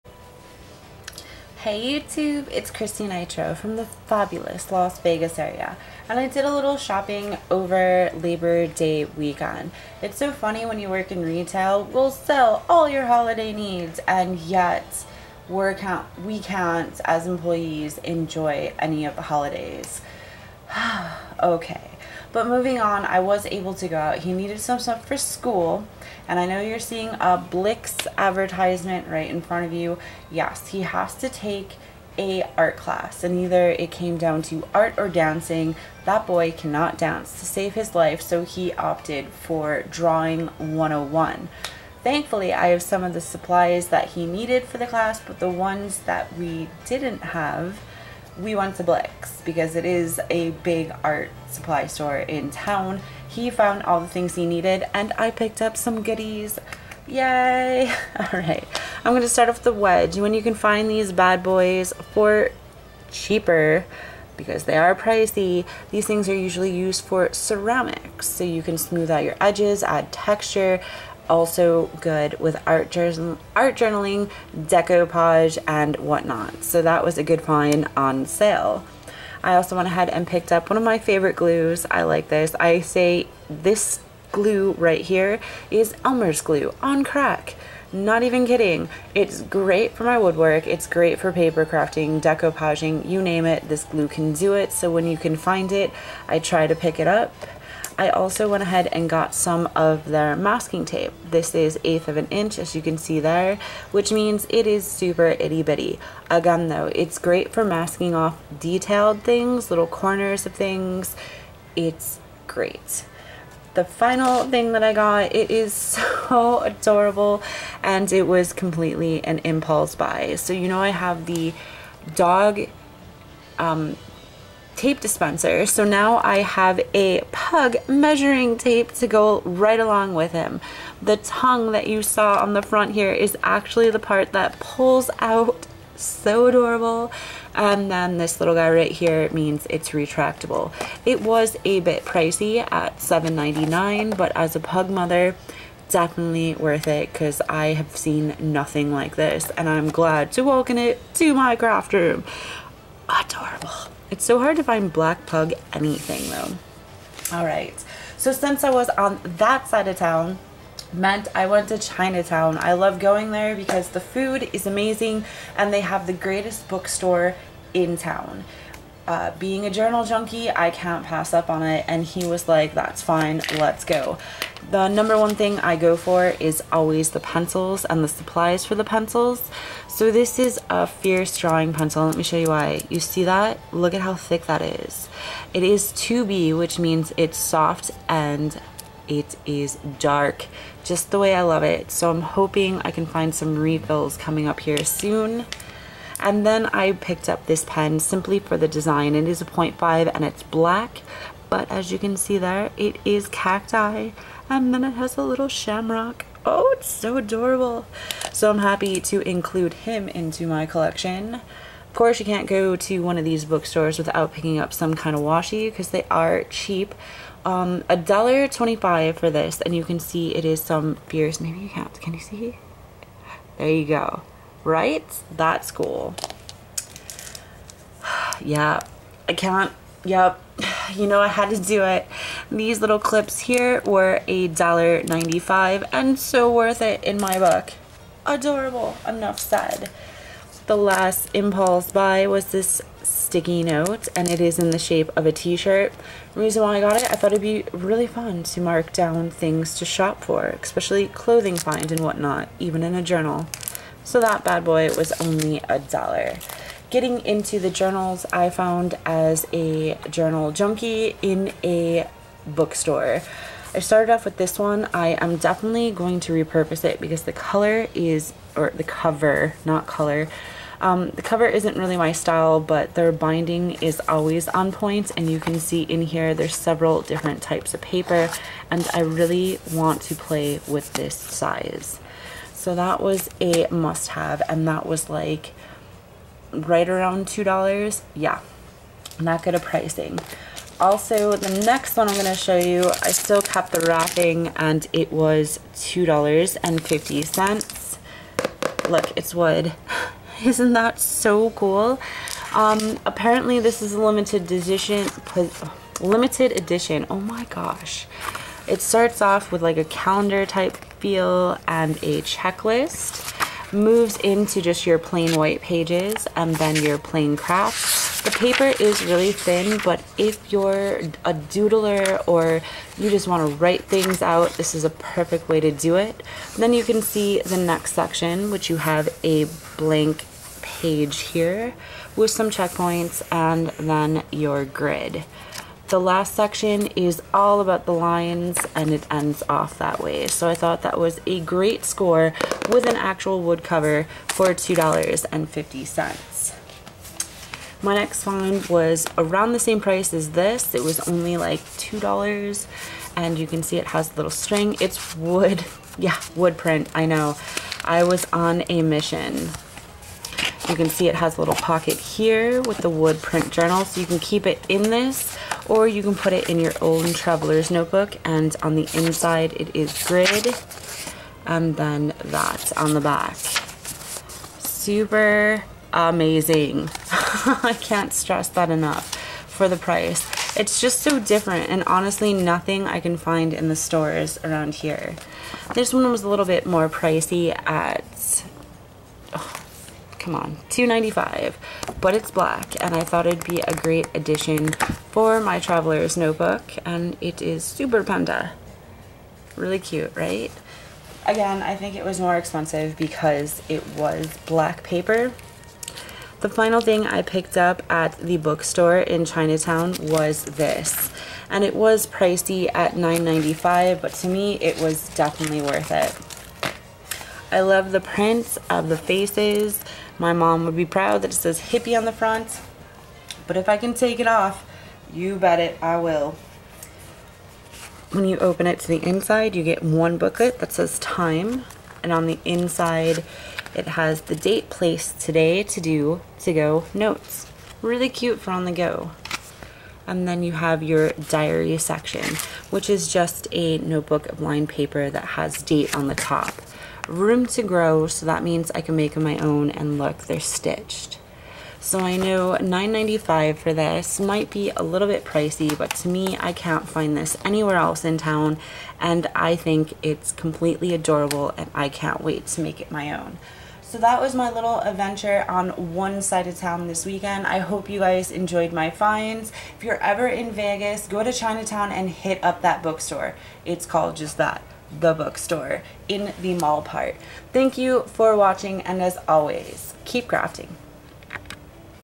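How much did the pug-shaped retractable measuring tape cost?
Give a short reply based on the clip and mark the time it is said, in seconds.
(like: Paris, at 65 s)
$7.99, at 142 s.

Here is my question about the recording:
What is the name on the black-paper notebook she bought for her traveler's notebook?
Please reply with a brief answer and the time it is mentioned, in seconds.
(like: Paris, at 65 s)
Super Panda, at 397 s.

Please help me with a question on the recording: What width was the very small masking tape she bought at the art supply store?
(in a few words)
1/8 inch.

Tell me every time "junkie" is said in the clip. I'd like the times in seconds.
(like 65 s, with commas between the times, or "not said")
170 s, 260 s.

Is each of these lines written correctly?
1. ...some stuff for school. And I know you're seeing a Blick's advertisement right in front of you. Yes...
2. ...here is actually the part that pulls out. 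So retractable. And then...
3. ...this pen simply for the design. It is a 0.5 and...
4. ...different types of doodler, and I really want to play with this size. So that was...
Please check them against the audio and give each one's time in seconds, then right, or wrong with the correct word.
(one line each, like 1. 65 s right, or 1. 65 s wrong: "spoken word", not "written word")
1. 24 s right
2. 132 s wrong: "adorable", not "retractable"
3. 197 s right
4. 277 s wrong: "paper", not "doodler".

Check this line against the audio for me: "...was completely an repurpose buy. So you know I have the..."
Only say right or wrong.
wrong.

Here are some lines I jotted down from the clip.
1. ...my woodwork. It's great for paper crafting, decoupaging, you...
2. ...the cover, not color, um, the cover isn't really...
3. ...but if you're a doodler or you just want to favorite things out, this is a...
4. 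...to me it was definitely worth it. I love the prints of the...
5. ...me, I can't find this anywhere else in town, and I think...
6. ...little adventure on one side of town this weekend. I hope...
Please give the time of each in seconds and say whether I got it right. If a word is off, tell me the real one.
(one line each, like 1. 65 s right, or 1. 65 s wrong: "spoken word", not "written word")
1. 90 s right
2. 268 s right
3. 319 s wrong: "write", not "favorite"
4. 414 s right
5. 456 s right
6. 464 s right.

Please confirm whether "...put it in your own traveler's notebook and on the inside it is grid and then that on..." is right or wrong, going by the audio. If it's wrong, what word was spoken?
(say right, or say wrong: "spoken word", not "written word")
right.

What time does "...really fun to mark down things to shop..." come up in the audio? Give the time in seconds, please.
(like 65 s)
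247 s.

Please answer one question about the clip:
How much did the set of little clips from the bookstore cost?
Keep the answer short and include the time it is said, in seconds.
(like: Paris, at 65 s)
$1.95, at 234 s.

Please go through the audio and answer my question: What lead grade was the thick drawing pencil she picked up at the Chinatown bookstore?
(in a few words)
2B.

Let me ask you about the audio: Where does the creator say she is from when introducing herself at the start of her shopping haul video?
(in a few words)
Las Vegas.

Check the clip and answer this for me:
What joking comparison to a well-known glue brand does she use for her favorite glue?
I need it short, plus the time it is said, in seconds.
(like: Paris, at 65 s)
Elmer's glue on crack, at 86 s.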